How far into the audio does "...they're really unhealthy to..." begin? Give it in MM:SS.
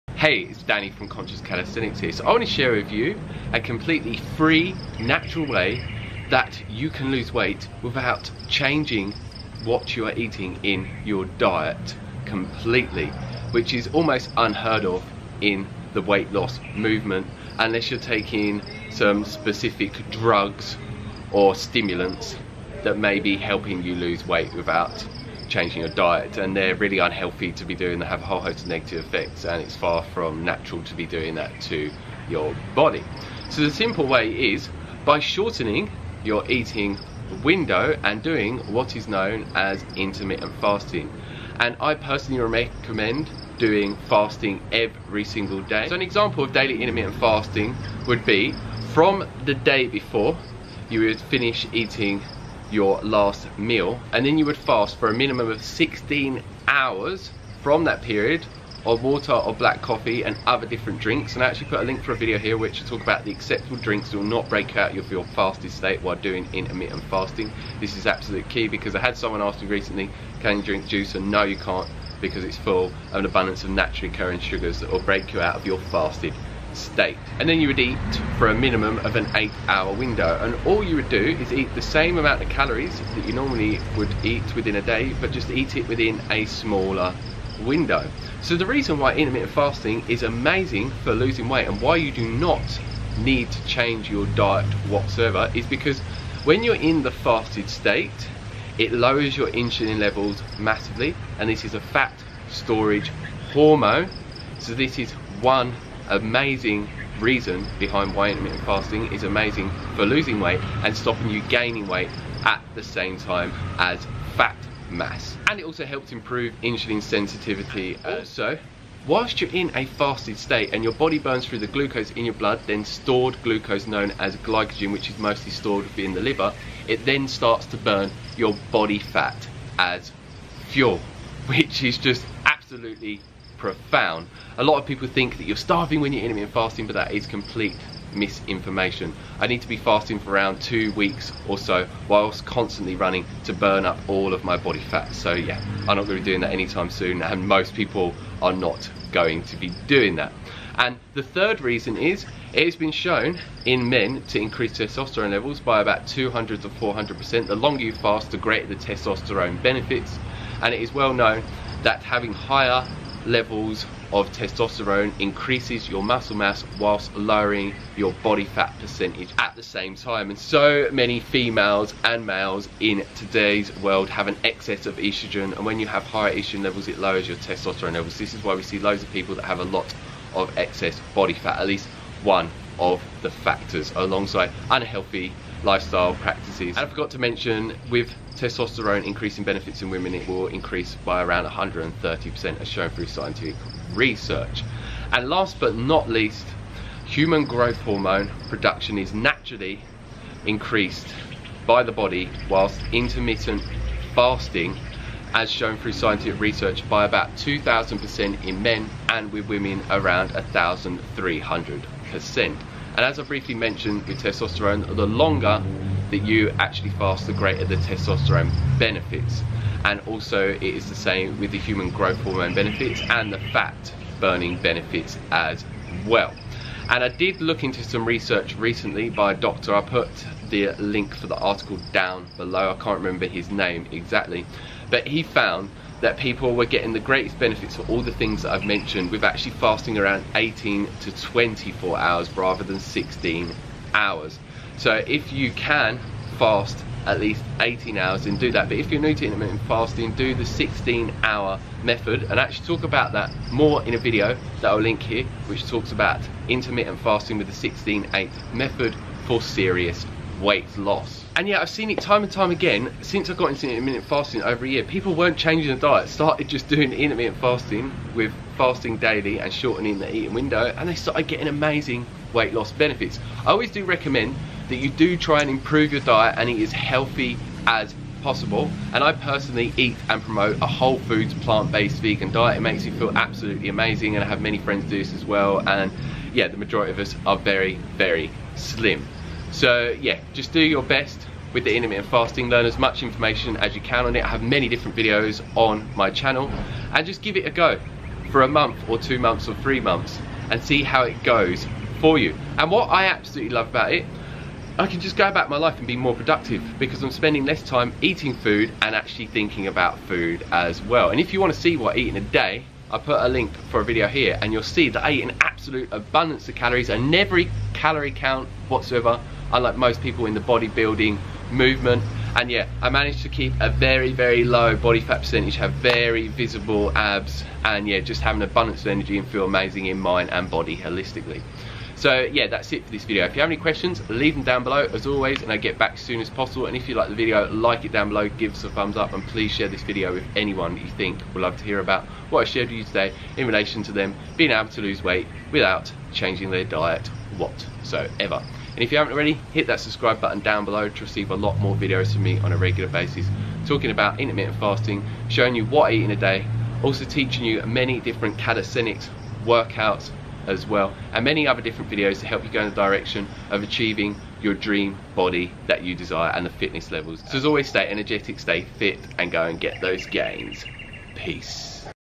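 00:26.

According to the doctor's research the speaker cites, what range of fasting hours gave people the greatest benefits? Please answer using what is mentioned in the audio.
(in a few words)
18 to 24 hours.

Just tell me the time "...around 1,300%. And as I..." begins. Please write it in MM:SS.
03:29.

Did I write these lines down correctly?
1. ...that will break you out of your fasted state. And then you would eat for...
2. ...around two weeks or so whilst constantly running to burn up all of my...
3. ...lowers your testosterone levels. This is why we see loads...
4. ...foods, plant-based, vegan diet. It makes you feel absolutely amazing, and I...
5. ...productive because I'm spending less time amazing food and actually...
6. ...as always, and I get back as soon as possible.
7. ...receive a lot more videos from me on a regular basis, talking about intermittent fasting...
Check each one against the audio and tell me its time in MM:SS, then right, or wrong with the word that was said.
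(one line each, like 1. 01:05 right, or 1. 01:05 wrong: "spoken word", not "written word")
1. 01:14 right
2. 02:20 right
3. 02:56 right
4. 04:40 right
5. 05:06 wrong: "eating", not "amazing"
6. 05:34 right
7. 05:51 right.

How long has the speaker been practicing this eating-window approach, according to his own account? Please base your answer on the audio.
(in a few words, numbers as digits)
over a year.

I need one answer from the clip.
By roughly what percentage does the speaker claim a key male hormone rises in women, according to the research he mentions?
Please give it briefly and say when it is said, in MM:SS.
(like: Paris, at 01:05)
130%, at 03:11.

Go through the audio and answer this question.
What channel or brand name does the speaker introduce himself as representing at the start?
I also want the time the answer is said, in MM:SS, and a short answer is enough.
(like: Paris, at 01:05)
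Conscious Calisthenics, at 00:01.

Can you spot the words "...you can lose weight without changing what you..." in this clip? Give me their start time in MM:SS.
00:06.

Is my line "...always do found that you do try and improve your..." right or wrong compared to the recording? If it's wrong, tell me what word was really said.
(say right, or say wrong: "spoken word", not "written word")
wrong: "recommend", not "found".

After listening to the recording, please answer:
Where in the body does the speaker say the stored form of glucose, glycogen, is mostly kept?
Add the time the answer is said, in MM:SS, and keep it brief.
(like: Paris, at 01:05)
the liver, at 02:06.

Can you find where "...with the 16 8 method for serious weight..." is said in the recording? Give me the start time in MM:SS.
04:17.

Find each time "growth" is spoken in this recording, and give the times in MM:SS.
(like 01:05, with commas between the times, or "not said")
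03:17, 03:41.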